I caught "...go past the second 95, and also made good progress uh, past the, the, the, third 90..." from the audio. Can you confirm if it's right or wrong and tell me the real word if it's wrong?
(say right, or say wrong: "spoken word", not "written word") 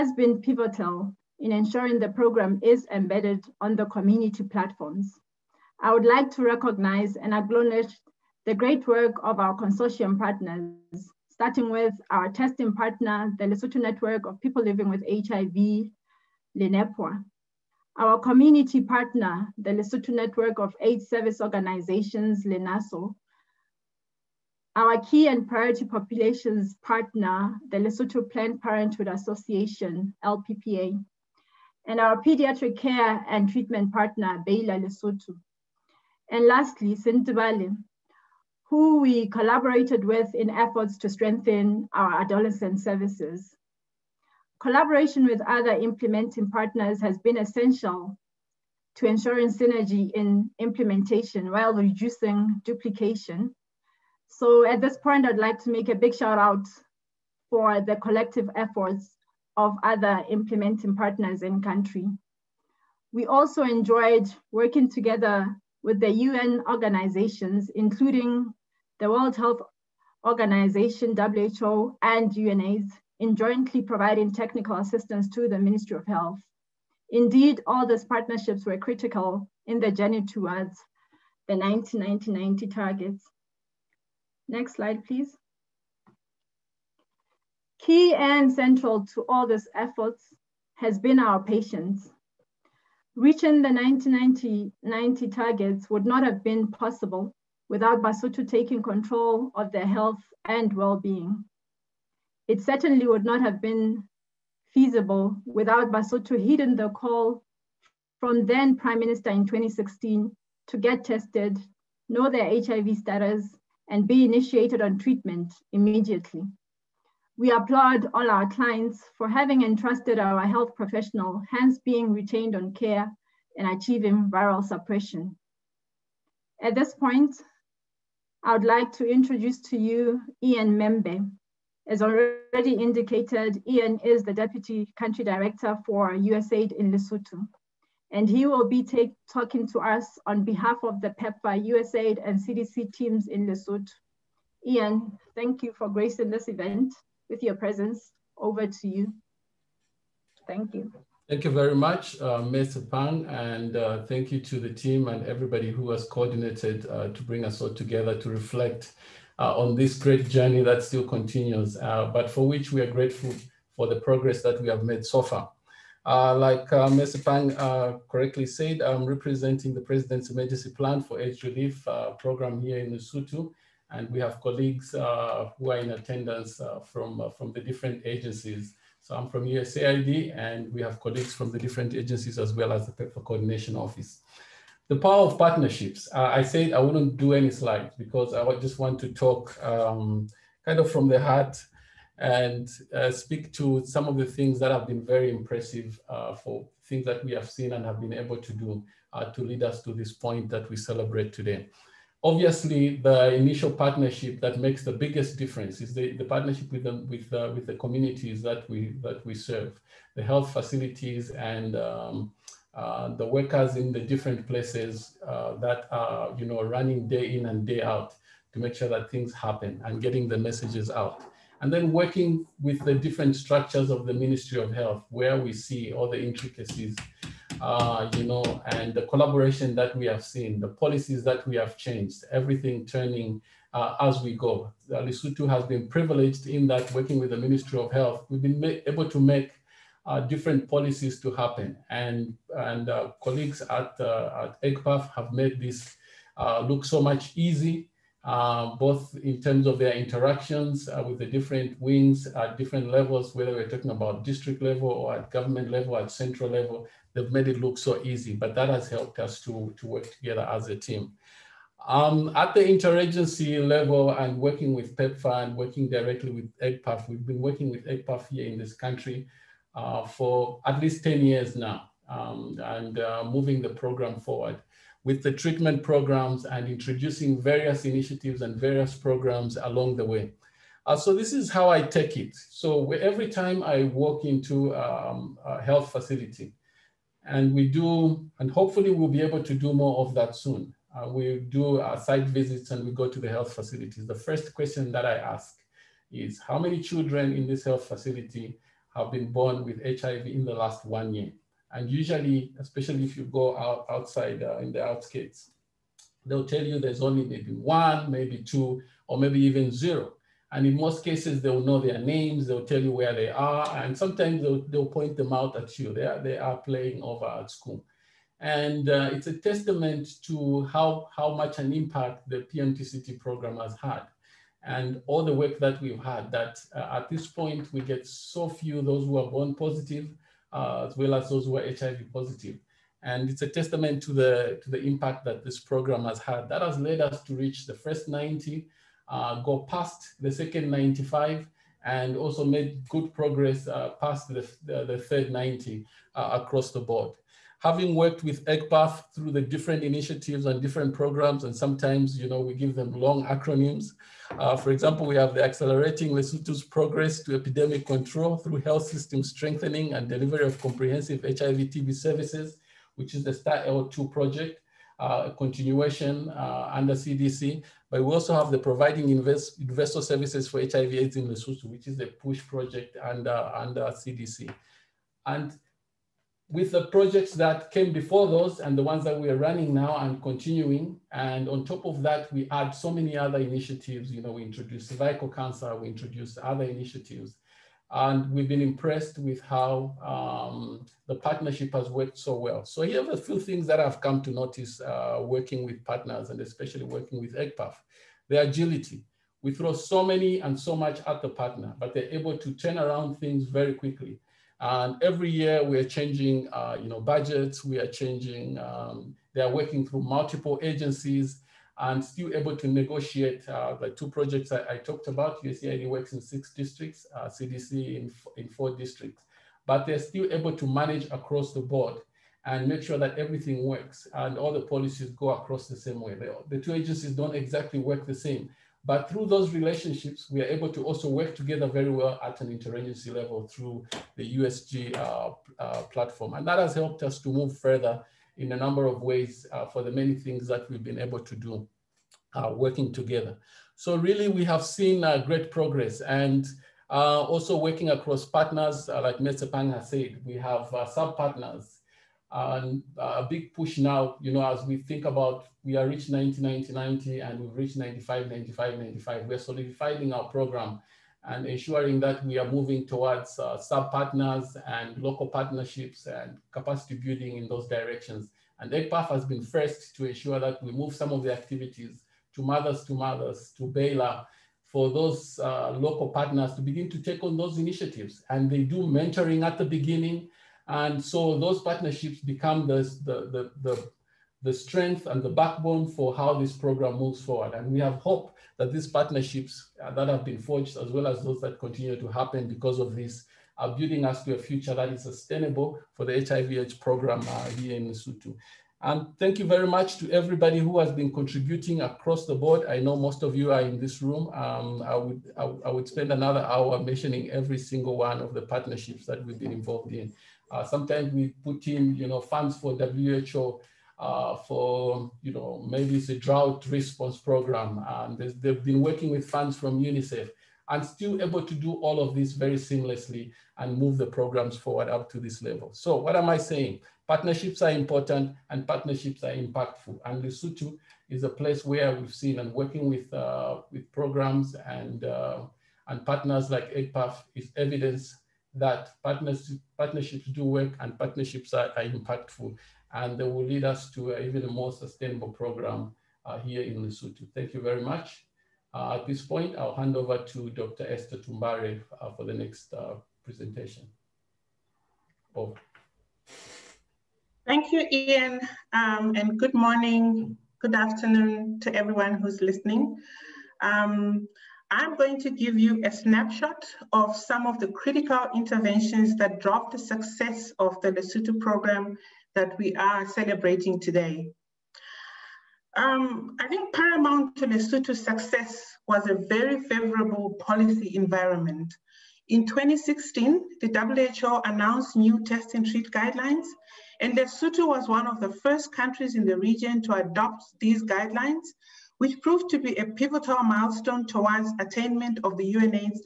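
right.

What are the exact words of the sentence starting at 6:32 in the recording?
So here are a few things that I've come to notice uh, working with partners and especially working with EGPAF, the agility.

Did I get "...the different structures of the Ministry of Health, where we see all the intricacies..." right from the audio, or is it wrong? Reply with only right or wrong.
right.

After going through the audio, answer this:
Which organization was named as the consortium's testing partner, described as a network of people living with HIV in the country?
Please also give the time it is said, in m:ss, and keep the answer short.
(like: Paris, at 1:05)
LENEPWHA, at 0:16.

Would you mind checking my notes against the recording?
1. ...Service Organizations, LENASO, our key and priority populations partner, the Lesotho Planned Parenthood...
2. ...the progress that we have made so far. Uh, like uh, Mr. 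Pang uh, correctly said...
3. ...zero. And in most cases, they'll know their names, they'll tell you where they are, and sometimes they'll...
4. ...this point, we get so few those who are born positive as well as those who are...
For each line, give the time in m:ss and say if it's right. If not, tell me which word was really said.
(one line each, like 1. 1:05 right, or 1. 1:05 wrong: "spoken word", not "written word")
1. 0:21 right
2. 2:43 right
3. 5:09 right
4. 5:27 right.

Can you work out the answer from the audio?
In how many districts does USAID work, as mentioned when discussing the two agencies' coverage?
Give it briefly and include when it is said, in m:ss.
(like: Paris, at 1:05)
6, at 6:56.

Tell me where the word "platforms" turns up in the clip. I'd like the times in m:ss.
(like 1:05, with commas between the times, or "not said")
0:04, 7:15.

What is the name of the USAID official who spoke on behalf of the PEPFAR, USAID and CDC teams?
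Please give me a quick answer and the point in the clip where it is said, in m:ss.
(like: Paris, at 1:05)
Ian Membe, at 2:10.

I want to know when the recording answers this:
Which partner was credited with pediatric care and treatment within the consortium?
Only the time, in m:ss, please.
0:34.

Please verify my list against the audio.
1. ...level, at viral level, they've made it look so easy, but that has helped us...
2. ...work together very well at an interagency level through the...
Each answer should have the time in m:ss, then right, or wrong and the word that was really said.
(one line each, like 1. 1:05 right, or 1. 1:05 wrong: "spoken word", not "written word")
1. 4:15 wrong: "central", not "viral"
2. 7:11 right.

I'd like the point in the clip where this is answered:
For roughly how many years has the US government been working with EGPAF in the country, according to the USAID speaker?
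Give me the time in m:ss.
4:31.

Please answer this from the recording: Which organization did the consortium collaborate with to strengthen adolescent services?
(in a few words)
Sentebale.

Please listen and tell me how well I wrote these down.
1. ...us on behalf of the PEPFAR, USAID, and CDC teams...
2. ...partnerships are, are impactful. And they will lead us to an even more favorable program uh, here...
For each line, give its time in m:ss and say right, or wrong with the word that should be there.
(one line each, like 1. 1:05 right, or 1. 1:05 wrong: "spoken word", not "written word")
1. 2:19 right
2. 9:00 wrong: "sustainable", not "favorable".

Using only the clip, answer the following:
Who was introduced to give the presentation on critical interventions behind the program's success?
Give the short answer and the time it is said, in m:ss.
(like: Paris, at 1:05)
Dr. Esther Tumbare, at 9:10.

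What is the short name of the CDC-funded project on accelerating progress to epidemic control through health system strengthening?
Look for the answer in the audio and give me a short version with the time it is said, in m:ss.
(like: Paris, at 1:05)
STAR-L2, at 6:03.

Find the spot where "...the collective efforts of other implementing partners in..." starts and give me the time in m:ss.
0:57.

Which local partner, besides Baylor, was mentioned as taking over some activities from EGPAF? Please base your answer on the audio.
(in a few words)
mothers2mothers.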